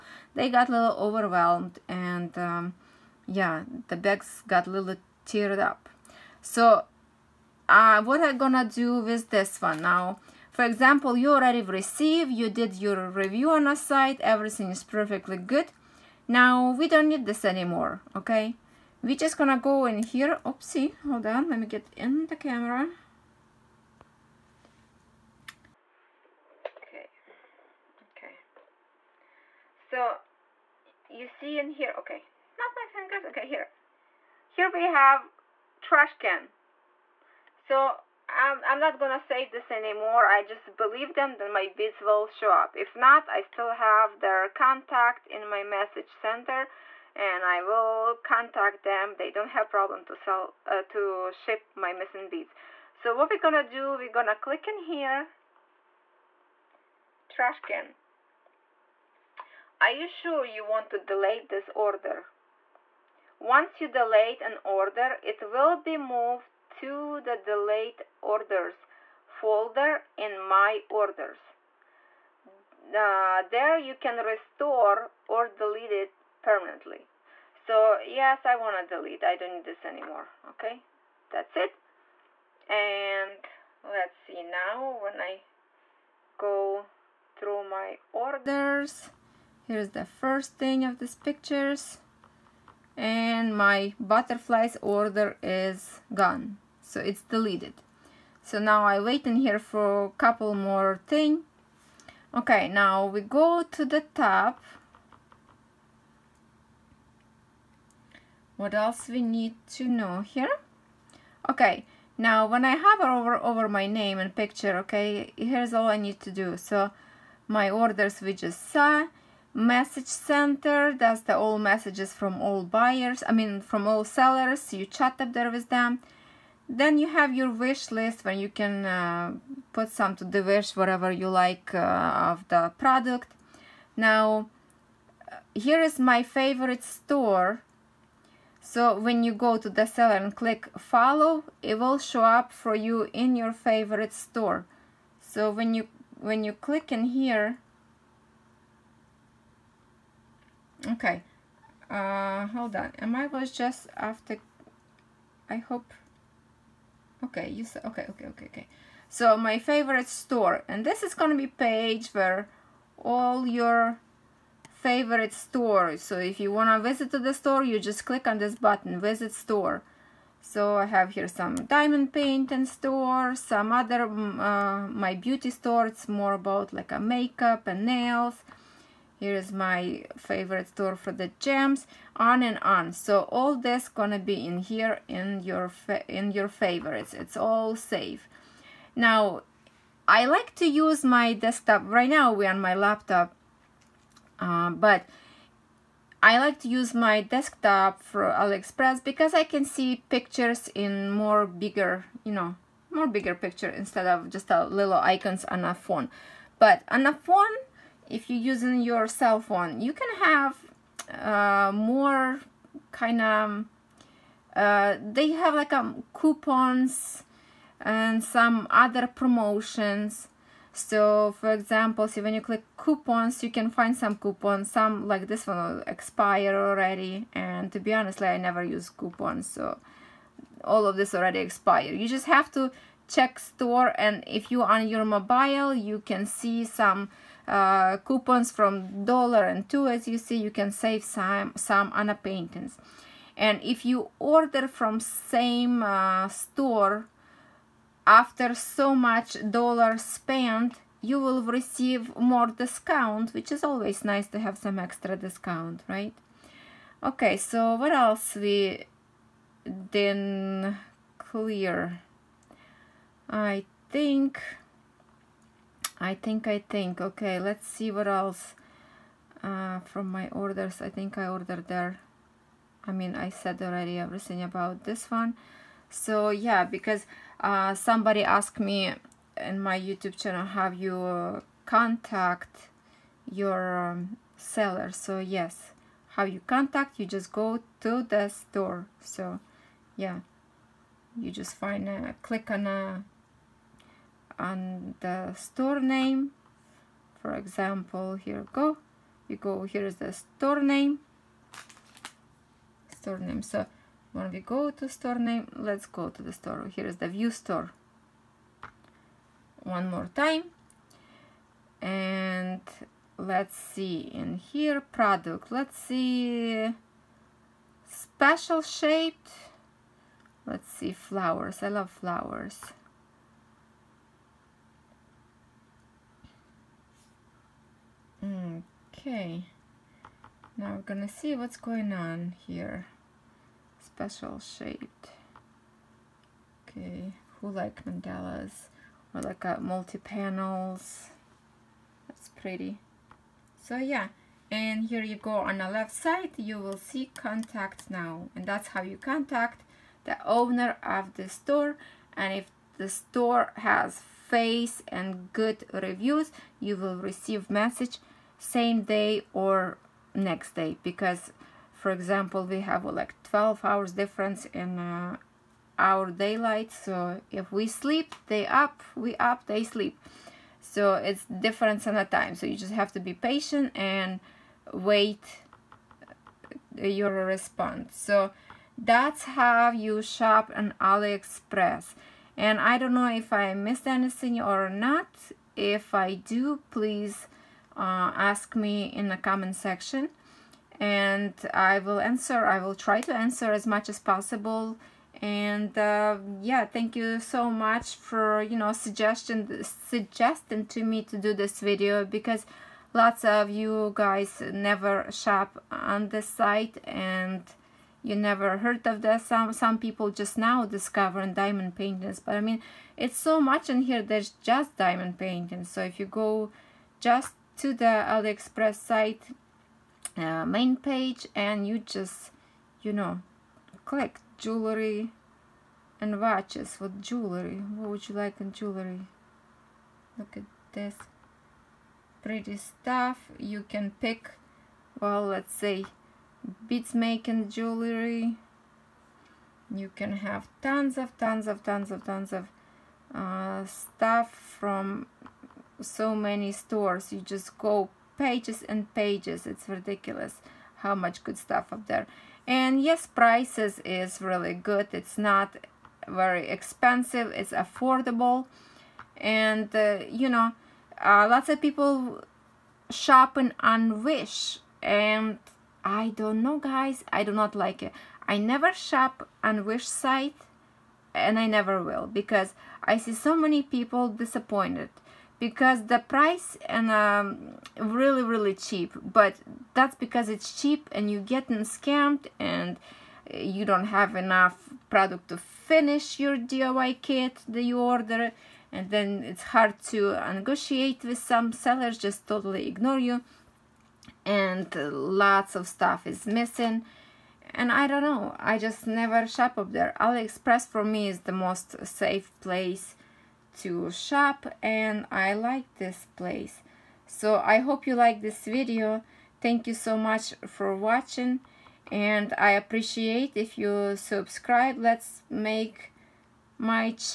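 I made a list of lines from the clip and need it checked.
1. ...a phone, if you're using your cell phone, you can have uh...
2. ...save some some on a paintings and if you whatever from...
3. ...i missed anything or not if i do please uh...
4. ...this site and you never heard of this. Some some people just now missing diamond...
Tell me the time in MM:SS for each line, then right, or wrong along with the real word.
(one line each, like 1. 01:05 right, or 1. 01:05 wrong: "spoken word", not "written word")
1. 03:27 right
2. 04:00 wrong: "order", not "whatever"
3. 06:23 right
4. 06:46 wrong: "discovering", not "missing".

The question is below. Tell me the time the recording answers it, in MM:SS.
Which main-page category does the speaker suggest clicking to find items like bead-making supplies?
07:04.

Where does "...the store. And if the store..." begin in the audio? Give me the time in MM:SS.
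05:51.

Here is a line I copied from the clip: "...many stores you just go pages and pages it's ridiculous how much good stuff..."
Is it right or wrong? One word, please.
right.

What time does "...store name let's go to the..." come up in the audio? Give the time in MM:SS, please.
05:04.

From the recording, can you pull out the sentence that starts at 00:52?
So what we're gonna do, we're gonna click in here trash can.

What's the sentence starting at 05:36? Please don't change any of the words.
Okay, who like mandalas or like a multi panels?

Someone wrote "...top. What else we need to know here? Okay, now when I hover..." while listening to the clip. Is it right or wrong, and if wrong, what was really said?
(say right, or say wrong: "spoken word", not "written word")
right.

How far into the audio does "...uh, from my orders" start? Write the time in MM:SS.
04:29.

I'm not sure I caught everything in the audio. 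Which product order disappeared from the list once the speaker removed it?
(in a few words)
Butterflies order.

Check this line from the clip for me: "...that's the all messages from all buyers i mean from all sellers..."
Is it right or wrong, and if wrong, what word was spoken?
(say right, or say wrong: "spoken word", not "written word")
right.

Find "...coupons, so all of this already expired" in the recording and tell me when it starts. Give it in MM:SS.
03:48.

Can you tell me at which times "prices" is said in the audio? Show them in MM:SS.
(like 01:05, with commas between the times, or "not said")
07:33, 07:55.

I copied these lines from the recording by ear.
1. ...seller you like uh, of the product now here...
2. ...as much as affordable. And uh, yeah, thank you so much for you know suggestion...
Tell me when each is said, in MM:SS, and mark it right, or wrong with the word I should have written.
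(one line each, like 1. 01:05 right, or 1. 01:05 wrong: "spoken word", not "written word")
1. 02:10 wrong: "whatever", not "seller"
2. 06:33 wrong: "possible", not "affordable".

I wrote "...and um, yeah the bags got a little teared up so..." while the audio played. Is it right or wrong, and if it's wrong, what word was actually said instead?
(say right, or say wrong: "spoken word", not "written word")
right.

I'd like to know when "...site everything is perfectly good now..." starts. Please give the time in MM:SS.
00:13.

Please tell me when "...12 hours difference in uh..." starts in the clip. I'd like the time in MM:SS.
06:03.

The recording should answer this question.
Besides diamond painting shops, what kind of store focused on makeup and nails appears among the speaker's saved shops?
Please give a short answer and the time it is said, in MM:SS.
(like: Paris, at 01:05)
Beauty store, at 02:55.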